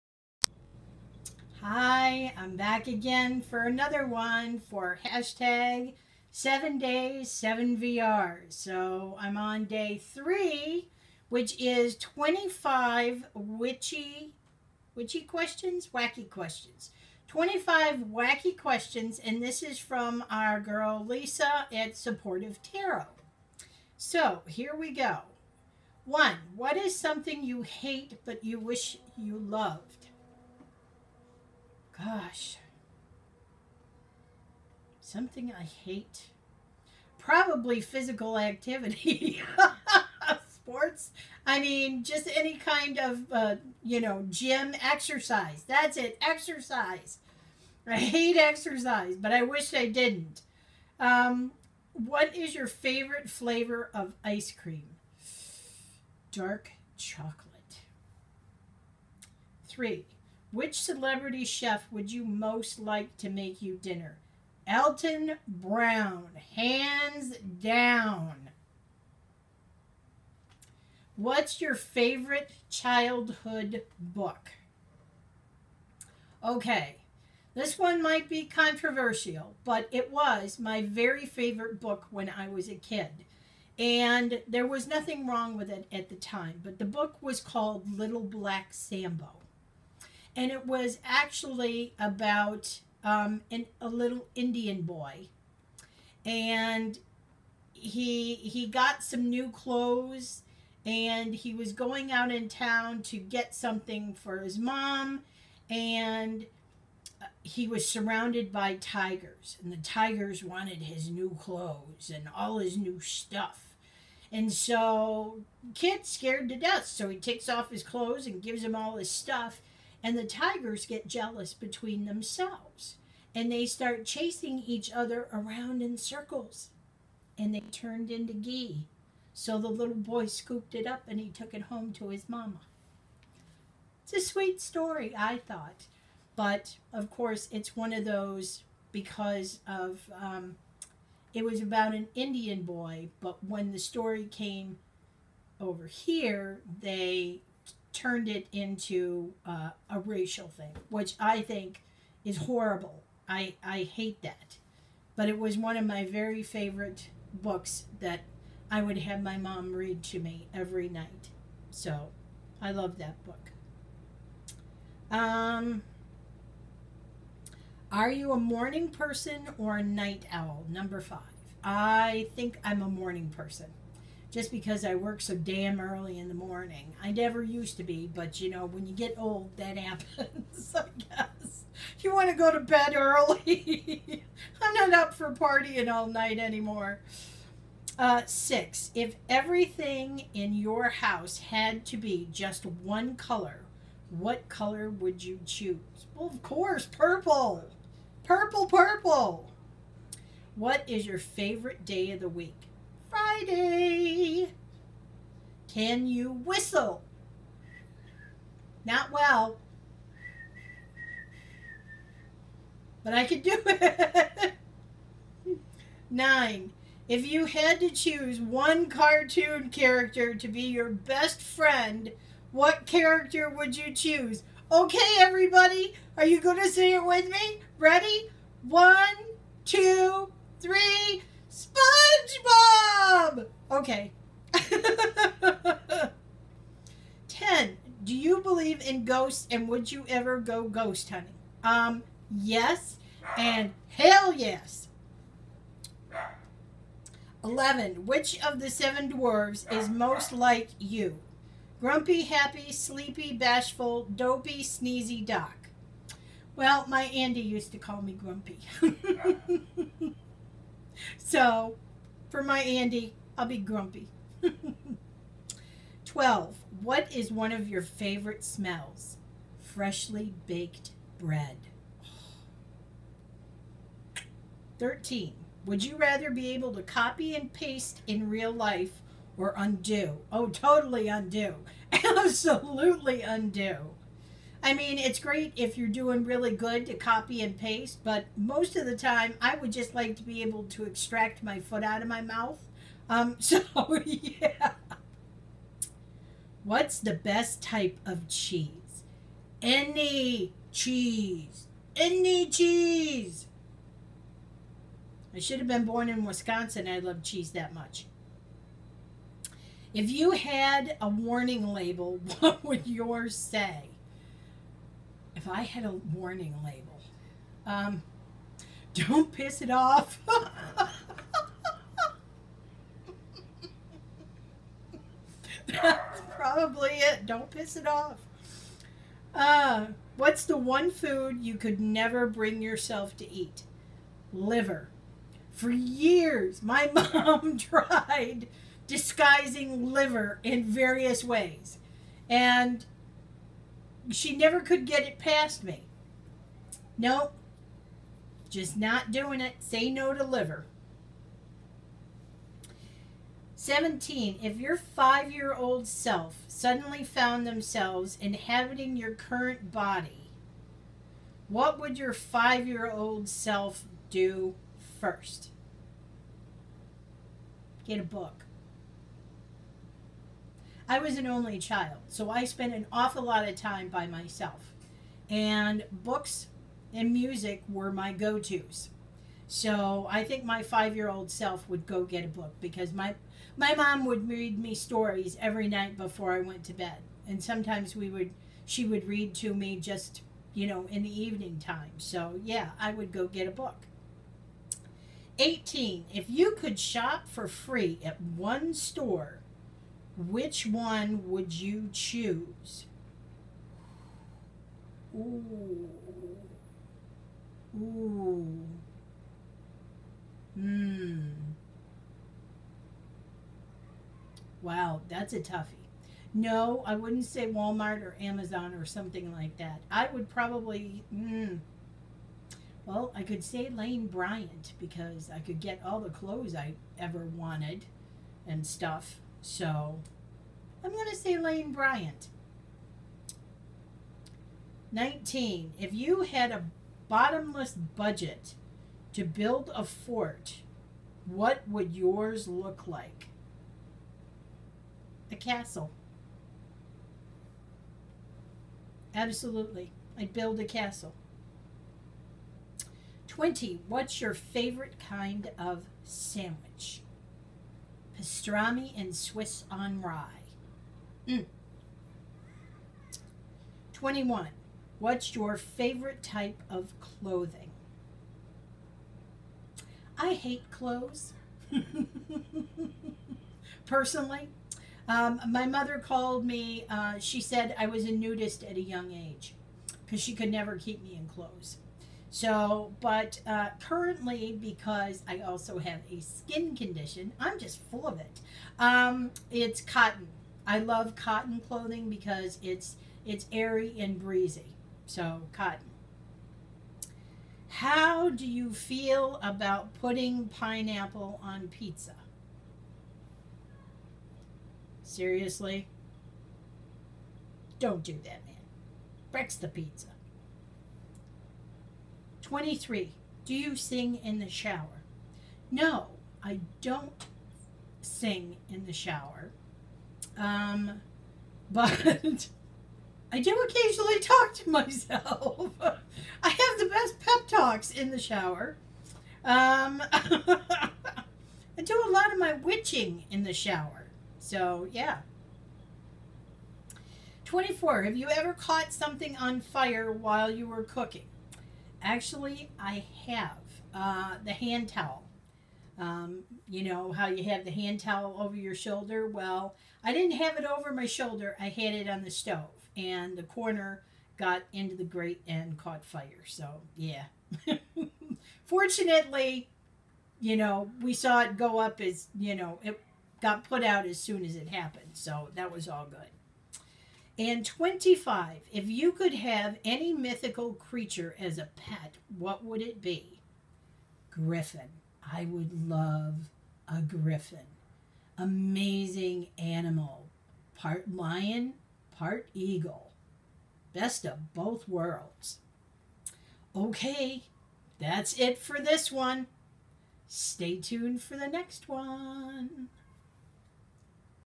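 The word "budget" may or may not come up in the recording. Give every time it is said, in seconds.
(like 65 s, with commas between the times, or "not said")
437 s.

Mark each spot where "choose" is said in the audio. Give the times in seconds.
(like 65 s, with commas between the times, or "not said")
195 s, 217 s, 223 s, 401 s.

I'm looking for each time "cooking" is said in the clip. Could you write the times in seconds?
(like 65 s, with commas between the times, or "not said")
540 s.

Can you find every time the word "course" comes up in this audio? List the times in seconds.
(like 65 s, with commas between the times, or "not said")
137 s, 196 s.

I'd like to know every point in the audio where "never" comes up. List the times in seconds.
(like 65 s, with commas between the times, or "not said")
177 s, 331 s, 344 s, 480 s.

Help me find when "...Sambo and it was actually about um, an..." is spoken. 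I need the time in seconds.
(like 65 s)
88 s.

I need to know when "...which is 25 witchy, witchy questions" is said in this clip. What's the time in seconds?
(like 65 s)
11 s.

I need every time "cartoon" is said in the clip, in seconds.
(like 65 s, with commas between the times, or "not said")
218 s.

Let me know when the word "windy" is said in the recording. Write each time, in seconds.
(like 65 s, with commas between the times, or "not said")
not said.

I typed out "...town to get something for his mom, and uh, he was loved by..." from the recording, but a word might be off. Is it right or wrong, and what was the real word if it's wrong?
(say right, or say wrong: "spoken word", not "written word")
wrong: "surrounded", not "loved".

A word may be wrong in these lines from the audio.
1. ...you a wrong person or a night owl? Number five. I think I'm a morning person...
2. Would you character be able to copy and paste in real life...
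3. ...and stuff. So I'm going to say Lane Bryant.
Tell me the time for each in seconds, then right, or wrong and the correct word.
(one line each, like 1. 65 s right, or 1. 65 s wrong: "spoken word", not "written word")
1. 168 s wrong: "morning", not "wrong"
2. 275 s wrong: "rather", not "character"
3. 428 s right.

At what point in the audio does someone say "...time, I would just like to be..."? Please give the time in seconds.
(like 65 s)
288 s.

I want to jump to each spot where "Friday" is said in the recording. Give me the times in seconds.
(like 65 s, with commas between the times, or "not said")
203 s.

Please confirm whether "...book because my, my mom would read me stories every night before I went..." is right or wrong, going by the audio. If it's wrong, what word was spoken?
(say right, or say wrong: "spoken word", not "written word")
right.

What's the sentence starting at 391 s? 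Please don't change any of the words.
So yeah, I would go get a book.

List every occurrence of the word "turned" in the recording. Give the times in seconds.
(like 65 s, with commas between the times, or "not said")
127 s, 147 s.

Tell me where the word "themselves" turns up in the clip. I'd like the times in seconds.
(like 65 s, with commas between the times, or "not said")
122 s, 357 s.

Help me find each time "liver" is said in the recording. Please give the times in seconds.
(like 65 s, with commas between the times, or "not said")
334 s, 339 s, 350 s.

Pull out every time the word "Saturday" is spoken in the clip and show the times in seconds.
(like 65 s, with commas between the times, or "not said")
not said.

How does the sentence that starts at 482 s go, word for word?
So, but uh, currently, because I also have a skin condition, I'm just full of it.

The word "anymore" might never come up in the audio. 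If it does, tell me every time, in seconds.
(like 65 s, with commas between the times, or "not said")
186 s.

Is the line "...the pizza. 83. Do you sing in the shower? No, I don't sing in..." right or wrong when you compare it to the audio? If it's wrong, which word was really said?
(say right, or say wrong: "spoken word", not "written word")
wrong: "23", not "83".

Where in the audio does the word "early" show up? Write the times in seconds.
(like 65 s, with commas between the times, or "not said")
175 s, 182 s.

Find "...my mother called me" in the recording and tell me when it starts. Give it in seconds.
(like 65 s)
475 s.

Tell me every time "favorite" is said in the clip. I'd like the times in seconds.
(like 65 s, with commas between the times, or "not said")
52 s, 71 s, 81 s, 156 s, 201 s, 267 s, 454 s, 465 s.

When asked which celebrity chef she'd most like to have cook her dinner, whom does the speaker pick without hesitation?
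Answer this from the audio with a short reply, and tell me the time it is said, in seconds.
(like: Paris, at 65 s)
Alton Brown, at 64 s.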